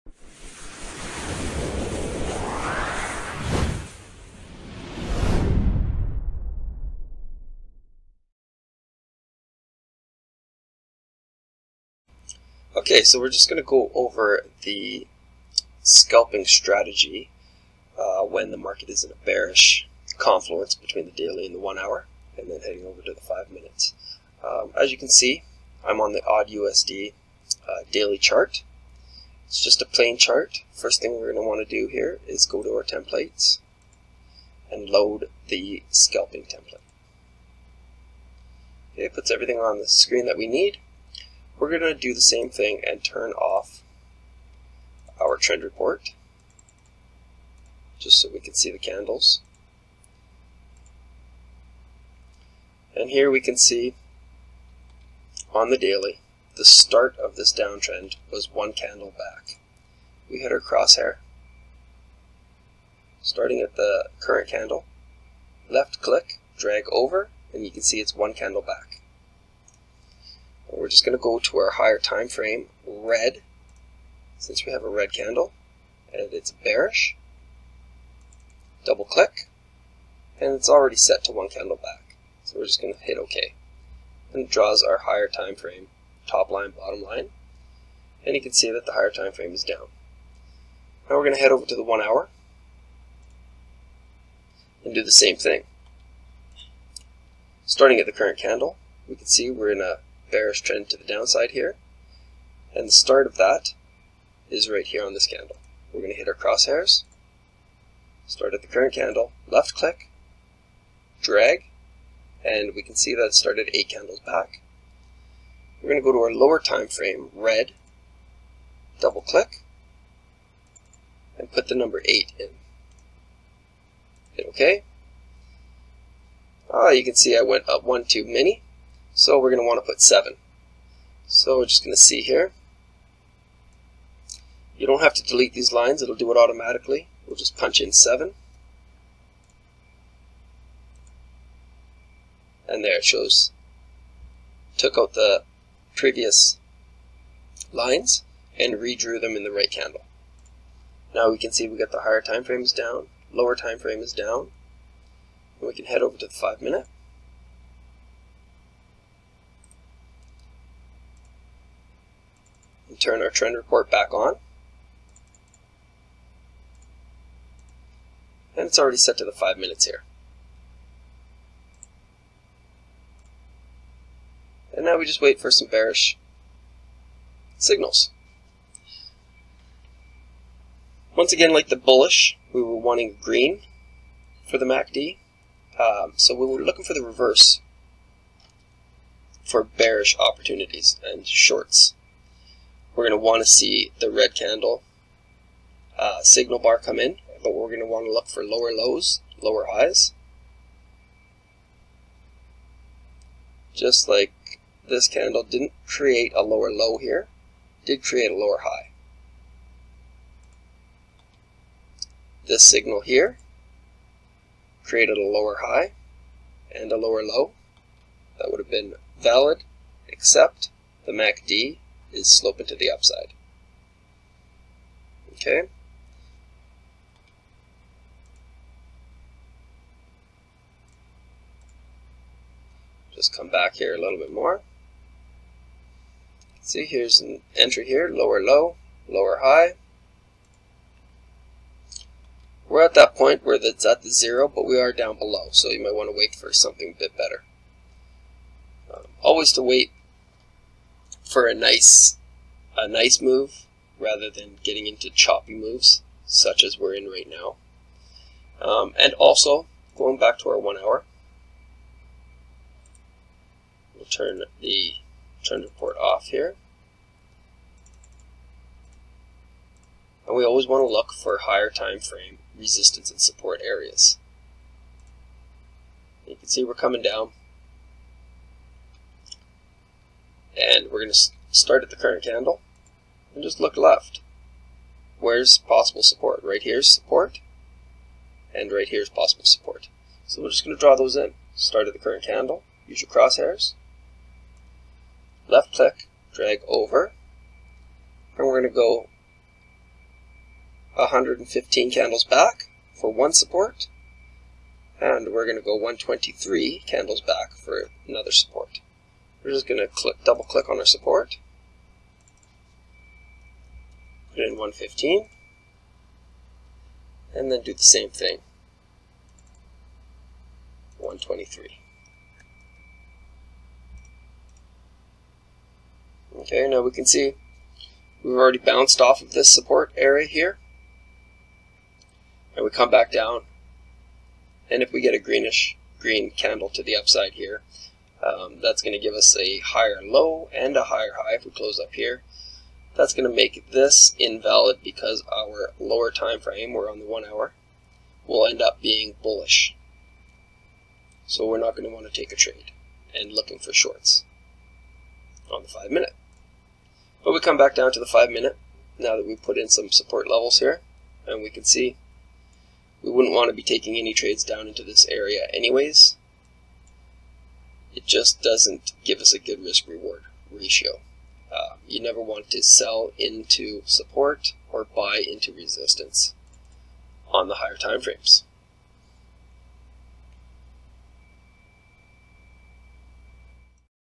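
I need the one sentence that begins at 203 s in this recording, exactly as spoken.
Just like this candle didn't create a lower low here, did create a lower high.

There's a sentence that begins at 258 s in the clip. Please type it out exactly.
Um, and also, going back to our one hour, we'll turn the trend report off here.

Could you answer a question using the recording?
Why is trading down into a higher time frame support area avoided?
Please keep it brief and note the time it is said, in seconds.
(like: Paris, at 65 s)
risk reward ratio, at 369 s.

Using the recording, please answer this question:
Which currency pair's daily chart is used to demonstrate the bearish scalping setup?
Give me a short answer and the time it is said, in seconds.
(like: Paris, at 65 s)
AUD USD, at 26 s.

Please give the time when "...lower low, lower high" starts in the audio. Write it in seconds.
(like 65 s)
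238 s.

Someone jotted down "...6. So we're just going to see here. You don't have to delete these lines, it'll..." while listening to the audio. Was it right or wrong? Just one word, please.
wrong.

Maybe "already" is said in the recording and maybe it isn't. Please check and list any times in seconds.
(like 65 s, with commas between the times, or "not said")
80 s, 168 s, 328 s.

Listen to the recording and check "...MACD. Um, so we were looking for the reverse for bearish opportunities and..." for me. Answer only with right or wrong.
right.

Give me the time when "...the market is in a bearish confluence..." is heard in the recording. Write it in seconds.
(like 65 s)
18 s.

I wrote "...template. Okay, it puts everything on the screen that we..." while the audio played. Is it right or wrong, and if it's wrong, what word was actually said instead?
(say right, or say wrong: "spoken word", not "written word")
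right.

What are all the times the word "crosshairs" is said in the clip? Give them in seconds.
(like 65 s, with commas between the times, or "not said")
60 s, 106 s, 293 s.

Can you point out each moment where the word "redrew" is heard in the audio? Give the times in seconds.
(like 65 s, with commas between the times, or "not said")
148 s.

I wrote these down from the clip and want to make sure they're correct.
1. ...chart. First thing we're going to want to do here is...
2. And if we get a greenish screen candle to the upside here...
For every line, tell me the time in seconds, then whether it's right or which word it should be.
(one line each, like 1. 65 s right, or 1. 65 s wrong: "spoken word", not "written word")
1. 30 s right
2. 334 s wrong: "green", not "screen".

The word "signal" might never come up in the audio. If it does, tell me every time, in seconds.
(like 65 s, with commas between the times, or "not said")
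177 s, 196 s, 212 s.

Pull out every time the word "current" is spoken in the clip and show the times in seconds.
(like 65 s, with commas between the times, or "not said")
64 s, 98 s, 108 s, 281 s, 291 s.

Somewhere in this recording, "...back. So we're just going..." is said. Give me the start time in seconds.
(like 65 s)
81 s.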